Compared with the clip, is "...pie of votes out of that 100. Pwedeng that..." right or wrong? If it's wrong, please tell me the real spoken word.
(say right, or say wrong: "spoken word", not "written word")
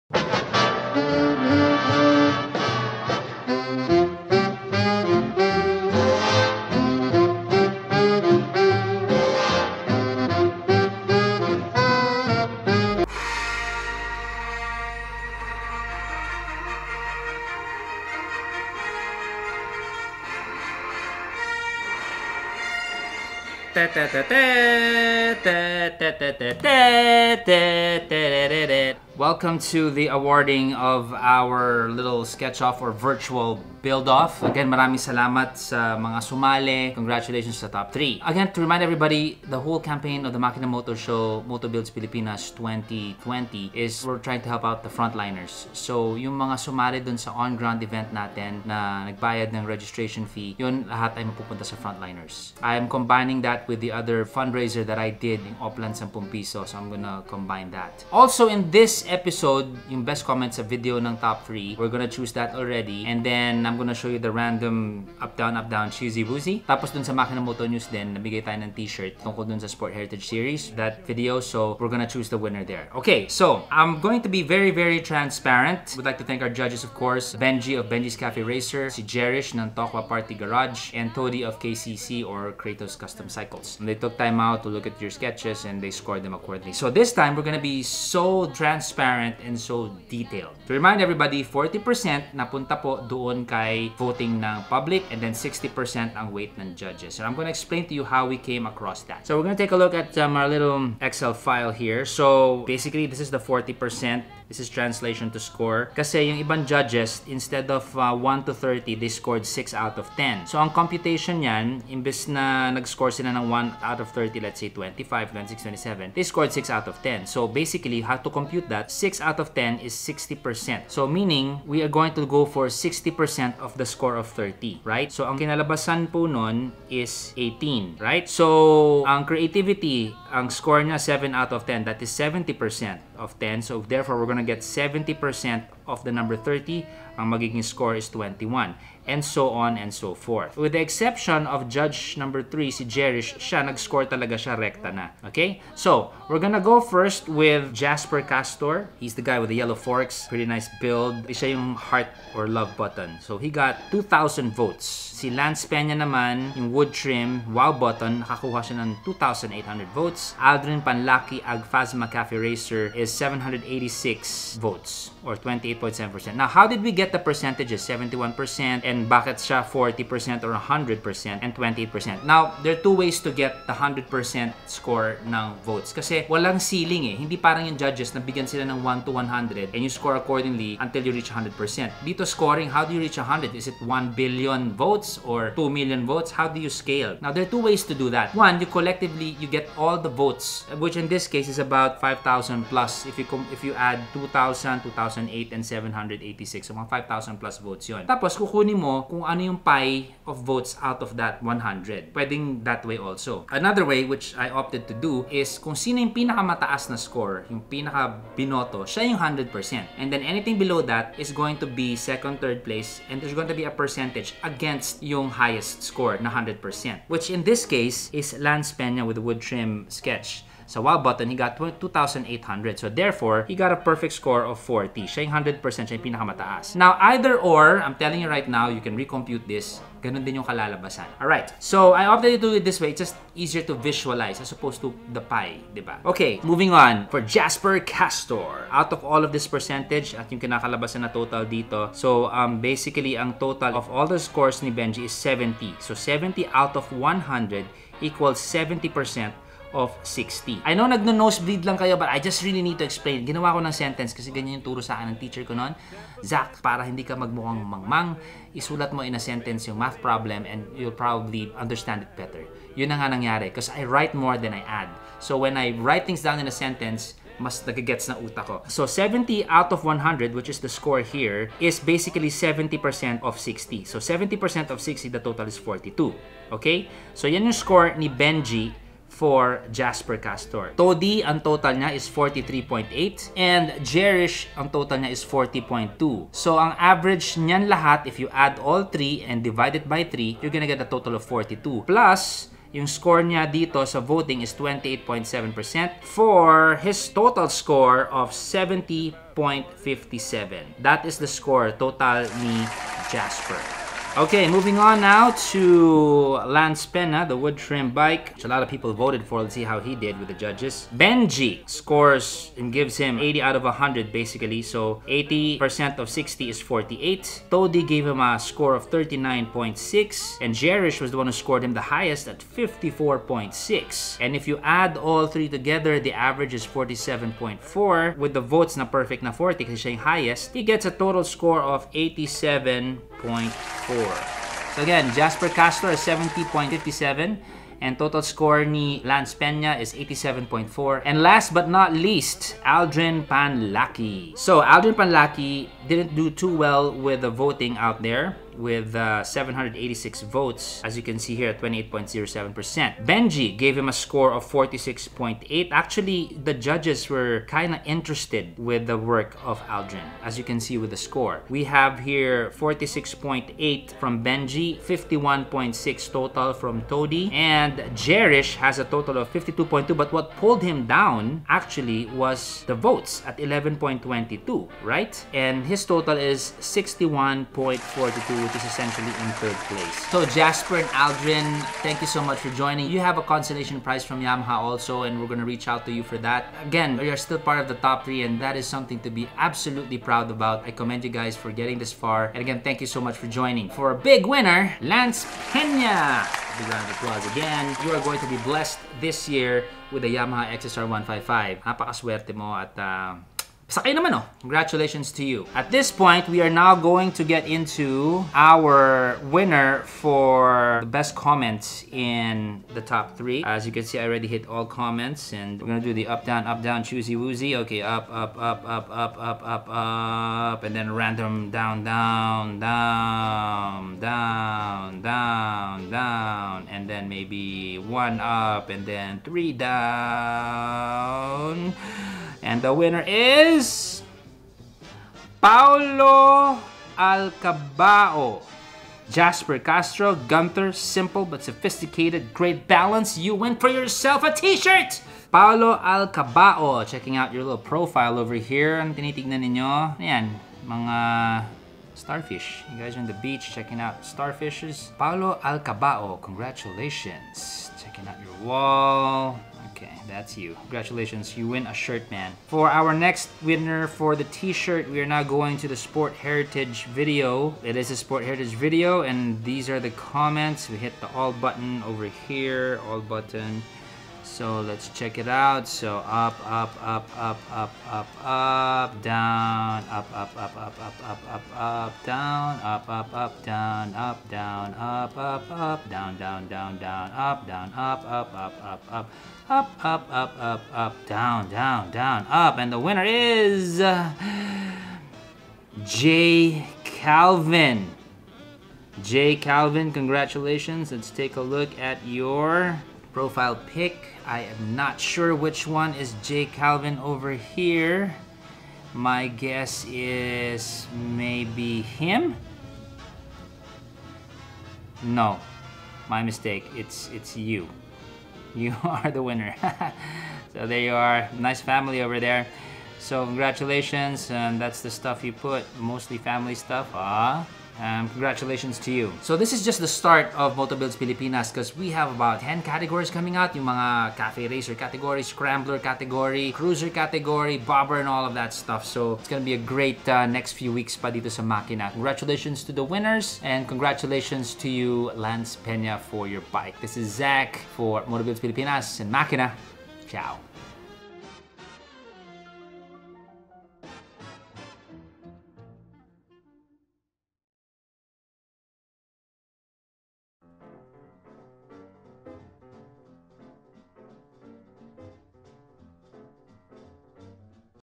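right.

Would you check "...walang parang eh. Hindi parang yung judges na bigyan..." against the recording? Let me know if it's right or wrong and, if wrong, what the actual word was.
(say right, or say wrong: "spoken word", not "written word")
wrong: "ceiling", not "parang".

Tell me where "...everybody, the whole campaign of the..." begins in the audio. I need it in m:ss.
0:38.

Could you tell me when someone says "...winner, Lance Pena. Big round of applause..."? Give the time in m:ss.
6:34.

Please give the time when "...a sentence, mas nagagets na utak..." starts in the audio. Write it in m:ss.
4:26.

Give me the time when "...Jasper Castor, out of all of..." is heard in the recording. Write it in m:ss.
3:57.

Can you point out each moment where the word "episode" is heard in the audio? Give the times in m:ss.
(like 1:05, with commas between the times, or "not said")
0:59.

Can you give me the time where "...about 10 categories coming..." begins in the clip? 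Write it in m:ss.
8:52.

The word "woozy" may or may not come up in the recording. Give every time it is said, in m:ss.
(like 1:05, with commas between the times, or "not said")
1:06, 6:57.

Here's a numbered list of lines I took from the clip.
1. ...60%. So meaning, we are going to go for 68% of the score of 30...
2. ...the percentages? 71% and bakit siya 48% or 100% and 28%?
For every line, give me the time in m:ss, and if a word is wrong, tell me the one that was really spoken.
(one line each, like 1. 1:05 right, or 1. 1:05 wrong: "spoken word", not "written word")
1. 1:59 wrong: "60", not "68"
2. 2:47 wrong: "40", not "48".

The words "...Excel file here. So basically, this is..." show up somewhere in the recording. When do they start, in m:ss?
1:40.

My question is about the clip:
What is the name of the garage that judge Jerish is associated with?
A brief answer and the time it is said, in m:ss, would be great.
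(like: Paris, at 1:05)
Tokwa Party Garage, at 1:19.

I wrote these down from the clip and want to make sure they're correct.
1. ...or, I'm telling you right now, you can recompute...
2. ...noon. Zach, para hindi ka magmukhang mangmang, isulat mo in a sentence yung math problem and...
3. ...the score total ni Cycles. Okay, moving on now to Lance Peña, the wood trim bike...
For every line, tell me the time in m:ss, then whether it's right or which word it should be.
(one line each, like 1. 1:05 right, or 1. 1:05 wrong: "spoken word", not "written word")
1. 3:47 right
2. 4:15 right
3. 5:01 wrong: "Jasper", not "Cycles".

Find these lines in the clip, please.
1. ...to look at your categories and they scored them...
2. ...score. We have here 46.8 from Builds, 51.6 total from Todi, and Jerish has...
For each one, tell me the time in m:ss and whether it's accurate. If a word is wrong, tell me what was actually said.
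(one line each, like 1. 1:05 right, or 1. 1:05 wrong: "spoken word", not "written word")
1. 1:24 wrong: "sketches", not "categories"
2. 6:00 wrong: "Benji", not "Builds".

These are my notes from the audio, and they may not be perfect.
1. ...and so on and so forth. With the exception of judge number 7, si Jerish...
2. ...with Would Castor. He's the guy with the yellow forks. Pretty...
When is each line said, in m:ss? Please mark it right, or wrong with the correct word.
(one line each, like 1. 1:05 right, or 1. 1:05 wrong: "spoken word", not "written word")
1. 2:19 wrong: "3", not "7"
2. 2:27 wrong: "Jasper", not "Would".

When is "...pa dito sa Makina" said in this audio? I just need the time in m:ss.
9:00.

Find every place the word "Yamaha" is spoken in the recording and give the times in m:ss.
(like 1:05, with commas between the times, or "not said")
6:24, 6:40.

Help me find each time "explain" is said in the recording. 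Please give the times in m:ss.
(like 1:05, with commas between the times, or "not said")
1:37, 4:12.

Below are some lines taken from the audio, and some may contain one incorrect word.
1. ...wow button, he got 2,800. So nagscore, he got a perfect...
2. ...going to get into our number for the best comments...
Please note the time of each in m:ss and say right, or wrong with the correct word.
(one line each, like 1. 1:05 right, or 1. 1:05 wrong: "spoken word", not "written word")
1. 3:40 wrong: "therefore", not "nagscore"
2. 6:46 wrong: "winner", not "number".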